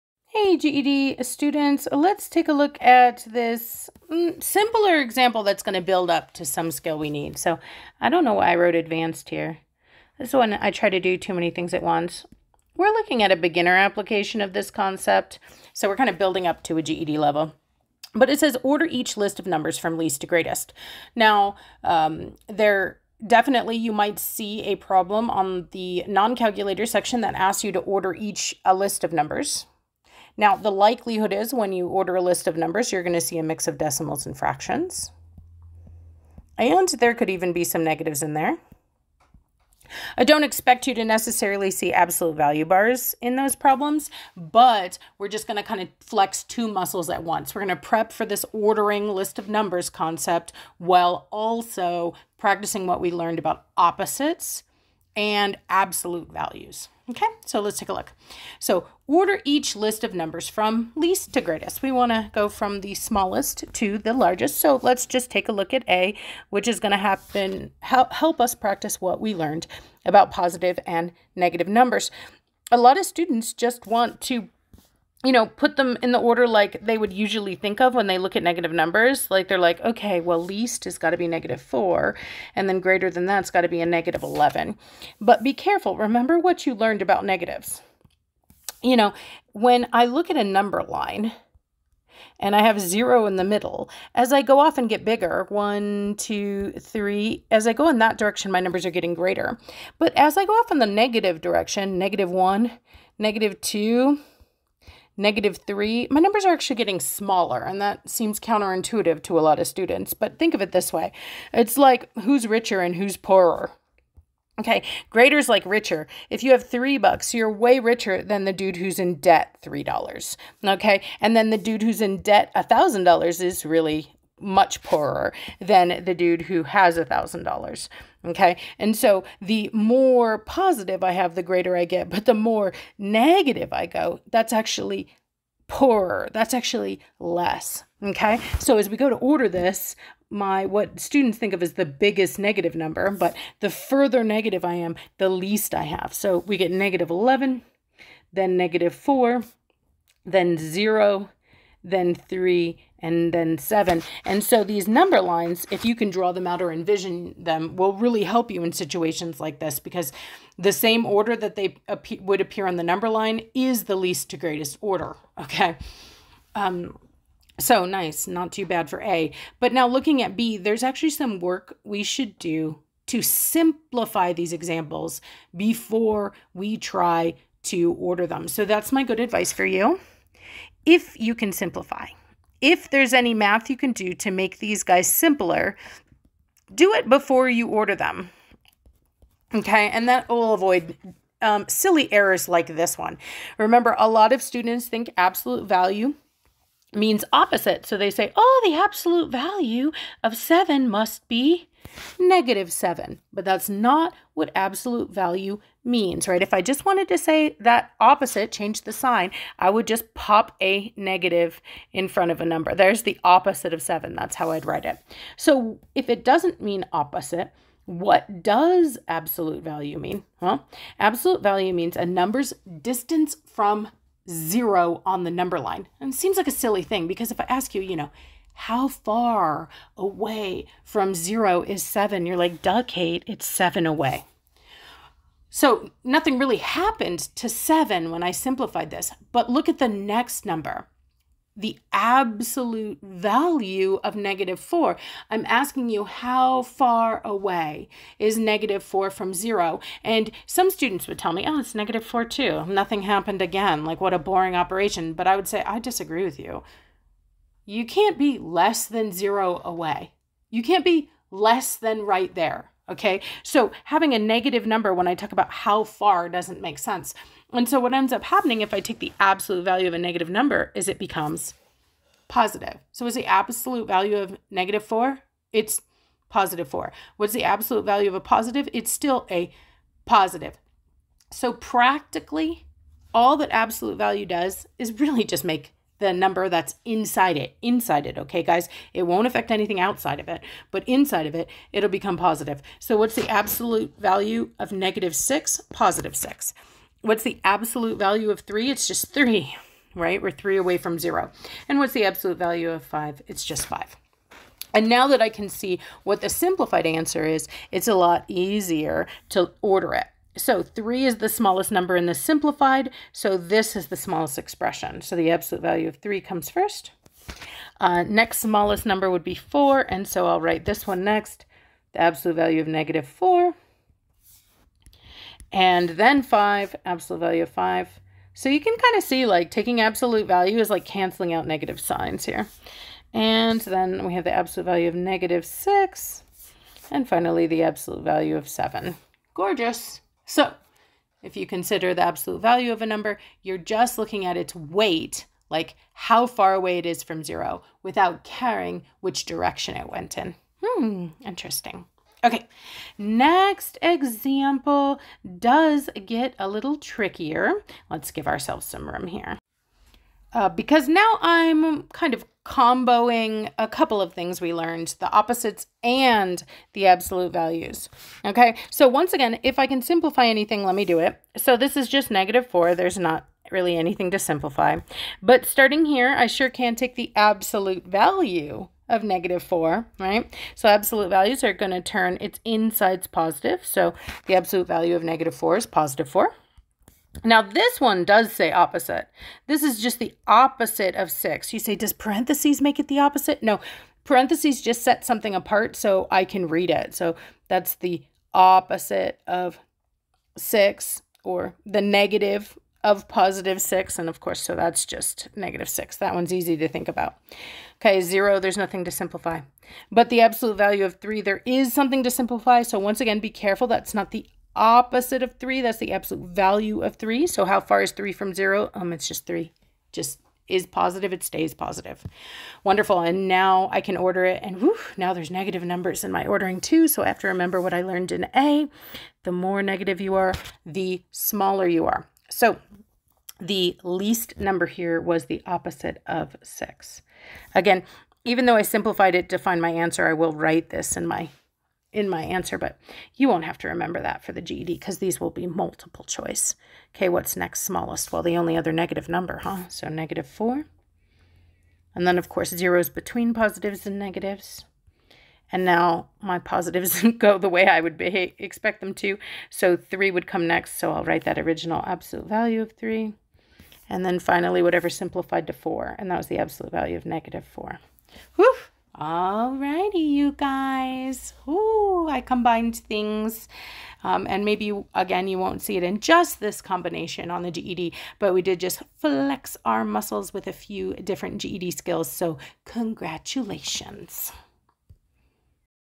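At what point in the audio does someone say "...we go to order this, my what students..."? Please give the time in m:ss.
2:18.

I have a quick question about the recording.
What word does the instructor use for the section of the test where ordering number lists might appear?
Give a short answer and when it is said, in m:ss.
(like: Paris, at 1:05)
non-calculator, at 0:26.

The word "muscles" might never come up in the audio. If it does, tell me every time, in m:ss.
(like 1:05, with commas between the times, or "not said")
0:46, 7:59.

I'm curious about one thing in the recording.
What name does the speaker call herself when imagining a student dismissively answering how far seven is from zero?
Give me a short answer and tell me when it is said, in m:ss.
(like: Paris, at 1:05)
Kate, at 3:52.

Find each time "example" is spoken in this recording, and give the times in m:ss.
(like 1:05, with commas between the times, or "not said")
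0:04, 2:54, 5:53.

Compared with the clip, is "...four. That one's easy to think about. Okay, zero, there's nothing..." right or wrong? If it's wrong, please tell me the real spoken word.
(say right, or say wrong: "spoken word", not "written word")
wrong: "six", not "four".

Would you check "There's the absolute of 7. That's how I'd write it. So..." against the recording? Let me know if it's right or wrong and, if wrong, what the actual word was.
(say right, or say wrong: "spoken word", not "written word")
wrong: "opposite", not "absolute".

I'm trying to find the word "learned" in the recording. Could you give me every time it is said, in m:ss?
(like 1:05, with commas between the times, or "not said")
0:53, 1:09, 1:26, 6:04, 7:07.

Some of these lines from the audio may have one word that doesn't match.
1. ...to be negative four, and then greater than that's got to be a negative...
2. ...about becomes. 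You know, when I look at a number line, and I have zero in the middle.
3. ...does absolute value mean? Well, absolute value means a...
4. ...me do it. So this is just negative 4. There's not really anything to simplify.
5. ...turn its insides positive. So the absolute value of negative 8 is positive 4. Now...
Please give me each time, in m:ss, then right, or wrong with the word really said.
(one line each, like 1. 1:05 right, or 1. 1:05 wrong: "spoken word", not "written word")
1. 1:21 right
2. 1:27 wrong: "negatives", not "becomes"
3. 3:38 right
4. 6:10 right
5. 6:21 wrong: "4", not "8".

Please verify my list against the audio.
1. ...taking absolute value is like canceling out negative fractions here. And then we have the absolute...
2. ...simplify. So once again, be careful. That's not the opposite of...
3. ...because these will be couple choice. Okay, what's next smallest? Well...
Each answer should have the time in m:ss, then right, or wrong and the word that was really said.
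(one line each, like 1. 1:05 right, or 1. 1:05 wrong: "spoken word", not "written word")
1. 5:29 wrong: "signs", not "fractions"
2. 6:52 right
3. 7:24 wrong: "multiple", not "couple".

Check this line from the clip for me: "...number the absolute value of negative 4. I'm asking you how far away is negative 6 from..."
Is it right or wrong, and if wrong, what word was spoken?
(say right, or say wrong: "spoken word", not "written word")
wrong: "4", not "6".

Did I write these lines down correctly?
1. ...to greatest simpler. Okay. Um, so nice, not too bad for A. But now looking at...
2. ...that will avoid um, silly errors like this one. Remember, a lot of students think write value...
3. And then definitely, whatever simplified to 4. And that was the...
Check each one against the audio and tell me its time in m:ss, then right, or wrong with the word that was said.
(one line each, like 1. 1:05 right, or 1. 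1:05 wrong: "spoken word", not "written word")
1. 2:44 wrong: "order", not "simpler"
2. 3:10 wrong: "absolute", not "write"
3. 7:43 wrong: "finally", not "definitely".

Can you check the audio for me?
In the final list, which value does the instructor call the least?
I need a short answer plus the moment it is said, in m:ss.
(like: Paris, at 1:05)
opposite of 6, at 7:15.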